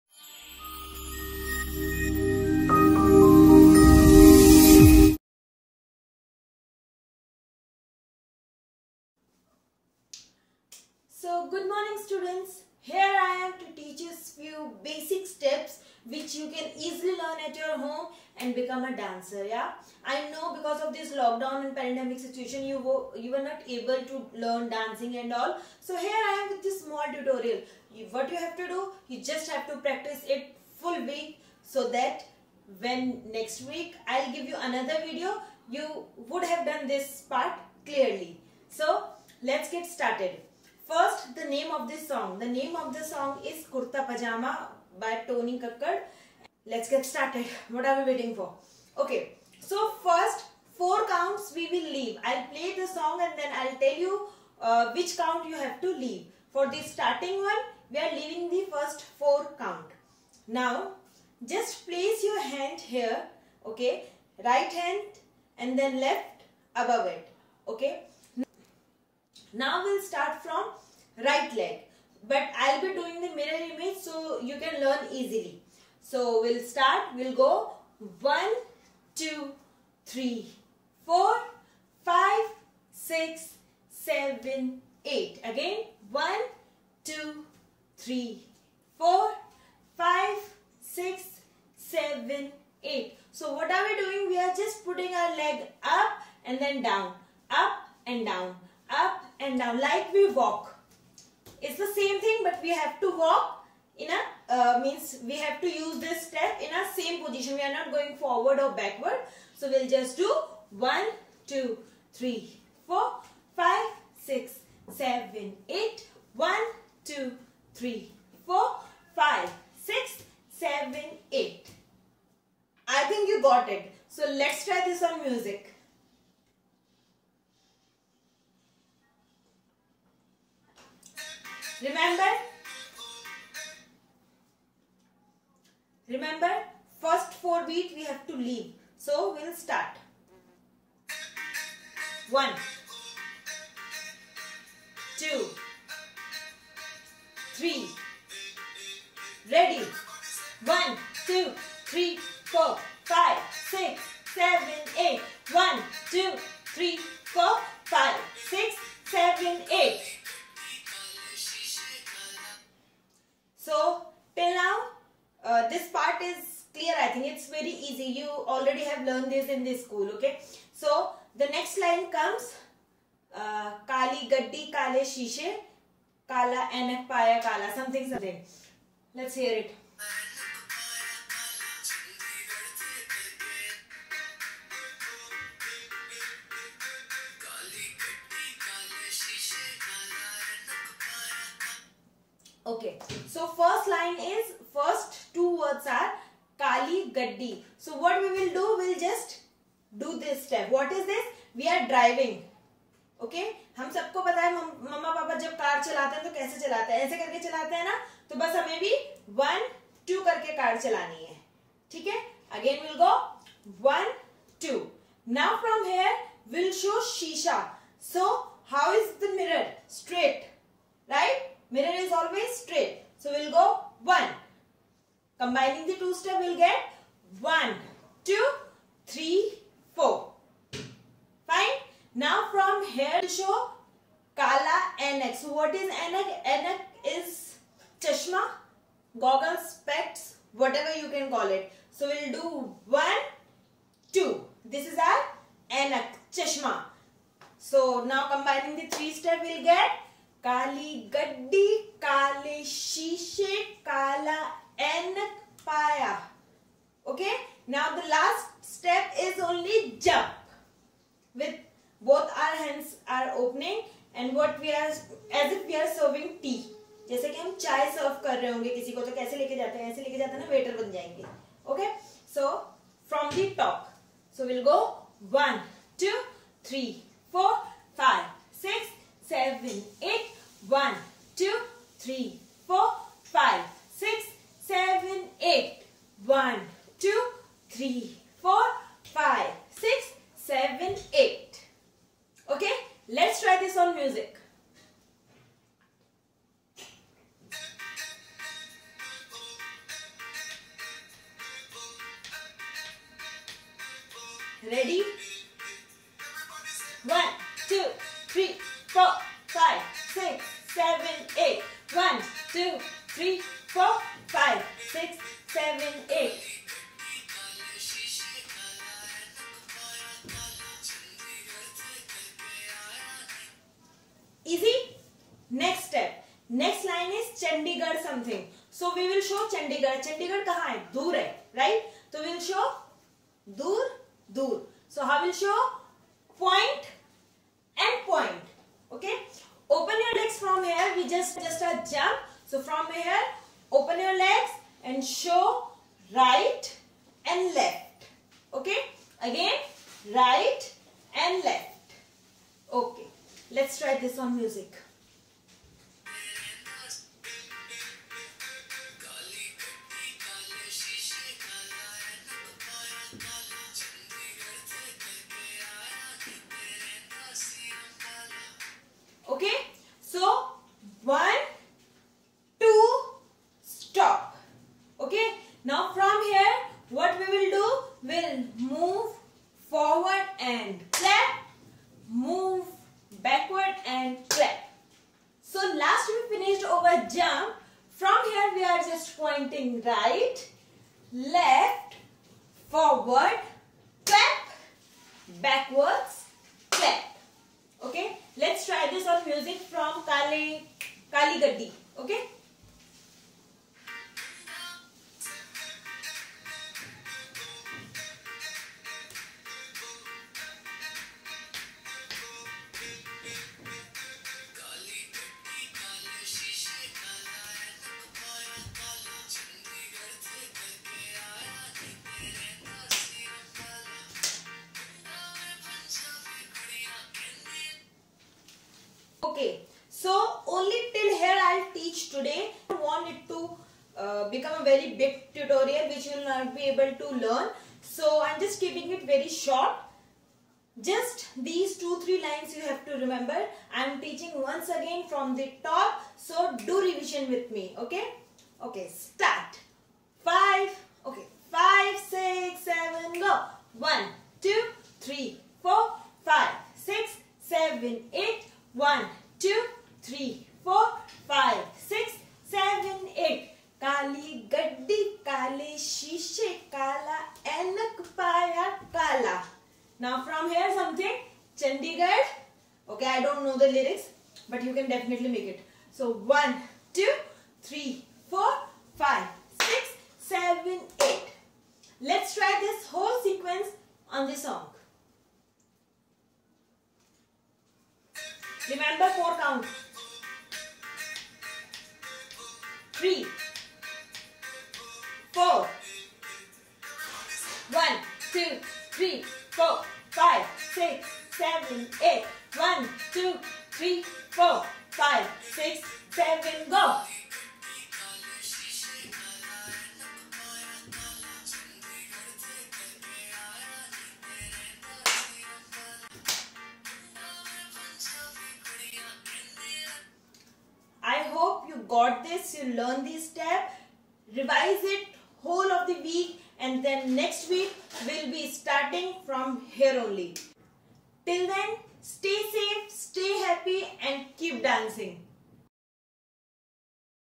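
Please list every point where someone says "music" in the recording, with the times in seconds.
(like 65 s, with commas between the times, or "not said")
125 s, 293 s, 399 s.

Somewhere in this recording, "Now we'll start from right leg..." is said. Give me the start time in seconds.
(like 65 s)
69 s.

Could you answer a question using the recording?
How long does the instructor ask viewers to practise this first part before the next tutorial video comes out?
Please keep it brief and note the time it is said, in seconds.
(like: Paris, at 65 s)
Full week, at 30 s.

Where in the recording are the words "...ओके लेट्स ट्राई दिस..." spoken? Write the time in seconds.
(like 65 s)
352 s.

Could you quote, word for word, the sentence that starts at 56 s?
For the starting one, we are leaving the first four count.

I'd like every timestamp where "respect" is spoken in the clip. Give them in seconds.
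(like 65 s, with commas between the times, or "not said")
not said.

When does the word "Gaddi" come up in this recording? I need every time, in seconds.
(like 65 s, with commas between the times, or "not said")
174 s, 197 s, 401 s.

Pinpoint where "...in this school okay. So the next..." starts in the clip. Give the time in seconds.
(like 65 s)
169 s.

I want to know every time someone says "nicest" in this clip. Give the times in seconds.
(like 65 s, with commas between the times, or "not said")
not said.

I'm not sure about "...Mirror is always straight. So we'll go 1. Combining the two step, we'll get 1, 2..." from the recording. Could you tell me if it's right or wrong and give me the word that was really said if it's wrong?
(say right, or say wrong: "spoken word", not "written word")
right.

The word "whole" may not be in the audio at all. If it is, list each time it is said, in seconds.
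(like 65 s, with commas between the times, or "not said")
482 s, 525 s.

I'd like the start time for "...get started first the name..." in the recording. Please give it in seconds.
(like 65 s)
39 s.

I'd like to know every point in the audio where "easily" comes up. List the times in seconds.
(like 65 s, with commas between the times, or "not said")
16 s, 75 s.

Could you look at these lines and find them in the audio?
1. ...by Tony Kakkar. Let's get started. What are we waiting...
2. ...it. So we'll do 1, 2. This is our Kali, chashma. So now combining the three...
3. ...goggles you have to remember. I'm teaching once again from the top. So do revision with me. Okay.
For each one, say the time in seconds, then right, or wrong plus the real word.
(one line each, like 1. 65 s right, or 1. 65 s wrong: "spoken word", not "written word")
1. 44 s right
2. 241 s wrong: "Anak", not "Kali"
3. 442 s wrong: "lines", not "goggles".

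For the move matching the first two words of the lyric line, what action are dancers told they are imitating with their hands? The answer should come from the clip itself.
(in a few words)
Driving.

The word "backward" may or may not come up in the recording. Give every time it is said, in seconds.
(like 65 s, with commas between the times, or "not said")
108 s, 395 s.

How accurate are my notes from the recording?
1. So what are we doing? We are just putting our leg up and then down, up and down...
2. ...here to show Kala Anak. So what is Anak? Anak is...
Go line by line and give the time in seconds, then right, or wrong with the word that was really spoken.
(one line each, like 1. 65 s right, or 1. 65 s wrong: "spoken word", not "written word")
1. 93 s right
2. 232 s right.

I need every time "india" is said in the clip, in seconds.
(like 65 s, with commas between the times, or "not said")
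not said.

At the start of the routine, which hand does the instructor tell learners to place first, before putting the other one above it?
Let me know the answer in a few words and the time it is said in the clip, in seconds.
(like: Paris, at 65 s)
Right hand, at 64 s.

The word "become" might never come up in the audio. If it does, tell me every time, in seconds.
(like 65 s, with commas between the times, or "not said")
18 s, 434 s.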